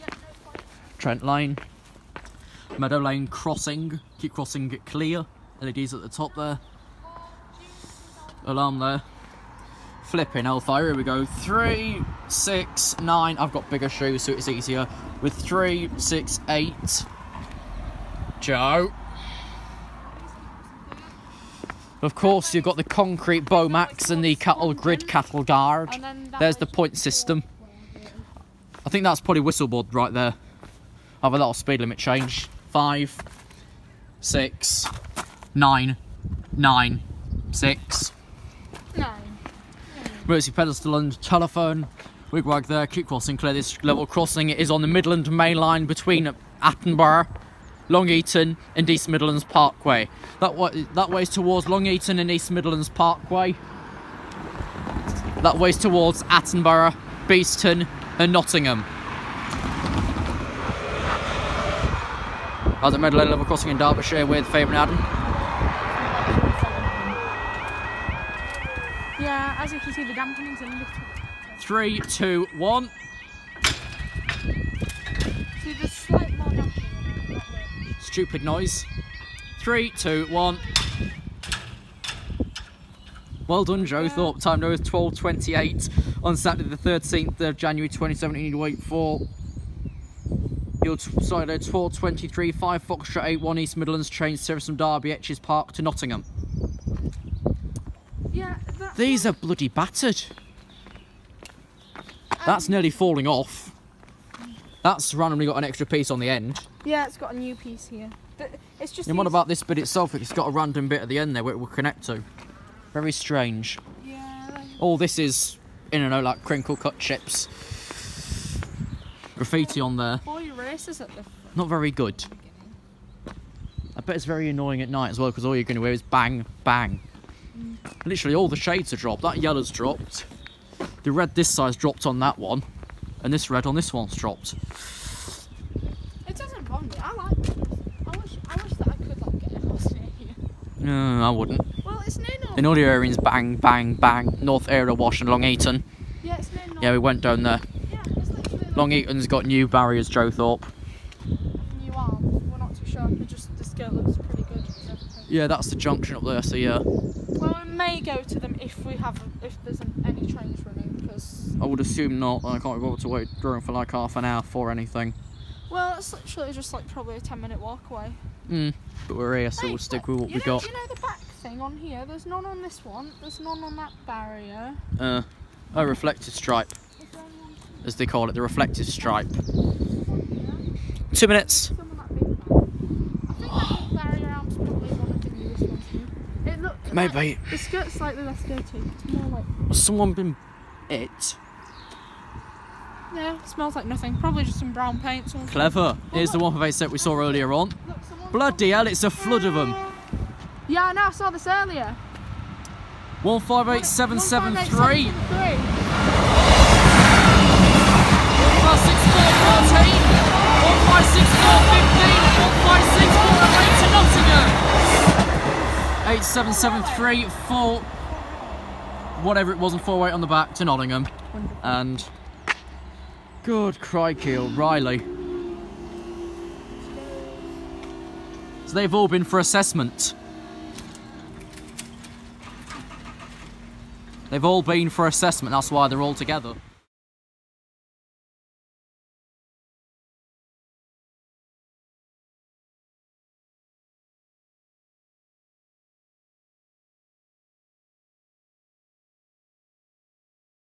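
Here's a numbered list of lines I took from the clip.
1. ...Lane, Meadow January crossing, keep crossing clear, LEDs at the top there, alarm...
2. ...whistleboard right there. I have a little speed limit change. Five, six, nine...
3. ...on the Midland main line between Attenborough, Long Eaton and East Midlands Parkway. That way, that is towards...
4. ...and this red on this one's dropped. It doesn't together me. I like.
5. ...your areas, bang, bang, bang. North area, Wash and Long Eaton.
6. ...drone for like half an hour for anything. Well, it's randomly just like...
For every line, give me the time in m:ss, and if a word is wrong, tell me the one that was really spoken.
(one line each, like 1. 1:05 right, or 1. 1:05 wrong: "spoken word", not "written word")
1. 0:01 wrong: "Lane", not "January"
2. 0:29 right
3. 0:44 right
4. 2:13 wrong: "bother", not "together"
5. 2:22 right
6. 2:43 wrong: "literally", not "randomly".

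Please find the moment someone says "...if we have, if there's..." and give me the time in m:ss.
2:38.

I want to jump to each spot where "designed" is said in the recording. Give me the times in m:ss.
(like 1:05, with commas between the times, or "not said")
not said.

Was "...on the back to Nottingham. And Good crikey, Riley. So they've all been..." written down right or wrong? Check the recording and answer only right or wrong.
right.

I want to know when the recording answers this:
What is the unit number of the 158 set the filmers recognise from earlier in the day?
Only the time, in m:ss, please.
3:23.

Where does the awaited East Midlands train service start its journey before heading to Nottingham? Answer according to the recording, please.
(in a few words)
Derby Etches Park.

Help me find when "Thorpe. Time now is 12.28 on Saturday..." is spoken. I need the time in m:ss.
1:24.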